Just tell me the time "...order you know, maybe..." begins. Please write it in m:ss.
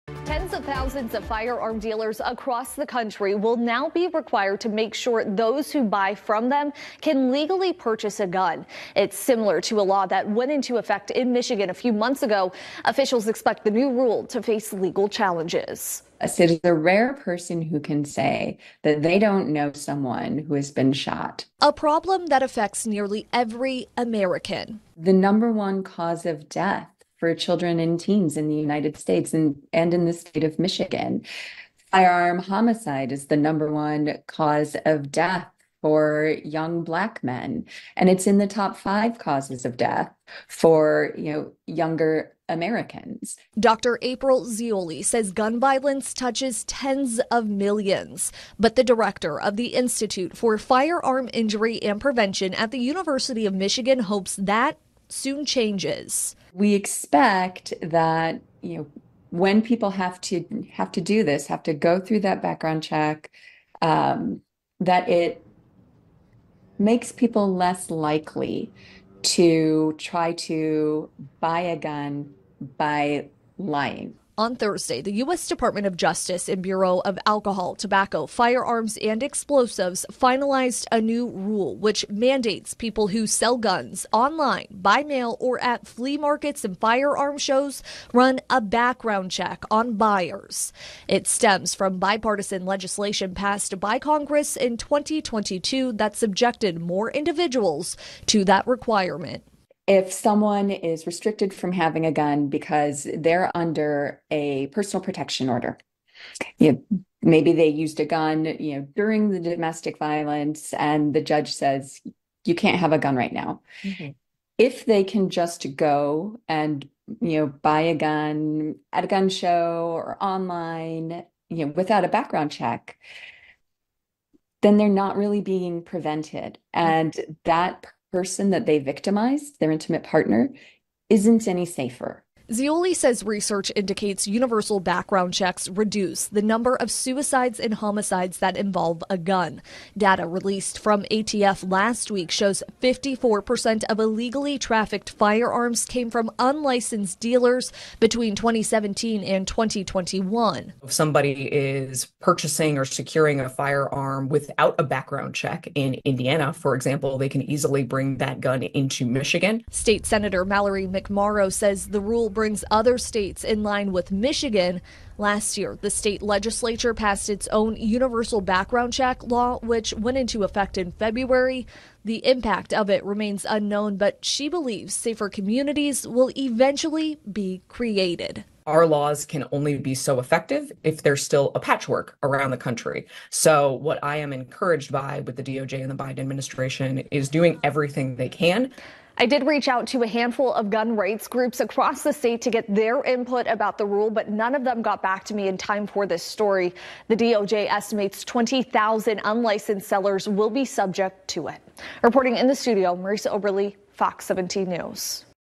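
1:45.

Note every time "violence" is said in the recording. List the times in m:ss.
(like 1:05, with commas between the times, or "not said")
0:45, 1:49.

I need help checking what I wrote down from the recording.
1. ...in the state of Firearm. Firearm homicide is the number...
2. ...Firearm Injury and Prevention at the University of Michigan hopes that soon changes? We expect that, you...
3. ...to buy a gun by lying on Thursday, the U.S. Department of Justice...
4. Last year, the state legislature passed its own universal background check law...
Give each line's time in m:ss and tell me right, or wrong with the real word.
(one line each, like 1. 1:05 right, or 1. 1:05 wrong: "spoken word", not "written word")
1. 0:29 wrong: "Michigan", not "Firearm"
2. 0:50 right
3. 1:10 right
4. 2:45 right.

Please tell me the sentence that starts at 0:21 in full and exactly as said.
A problem that affects nearly every American.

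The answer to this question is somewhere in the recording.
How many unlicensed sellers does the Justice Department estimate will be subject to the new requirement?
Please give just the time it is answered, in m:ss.
3:18.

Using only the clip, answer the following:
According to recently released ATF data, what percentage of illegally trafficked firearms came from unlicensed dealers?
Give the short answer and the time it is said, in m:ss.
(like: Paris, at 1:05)
54%, at 2:22.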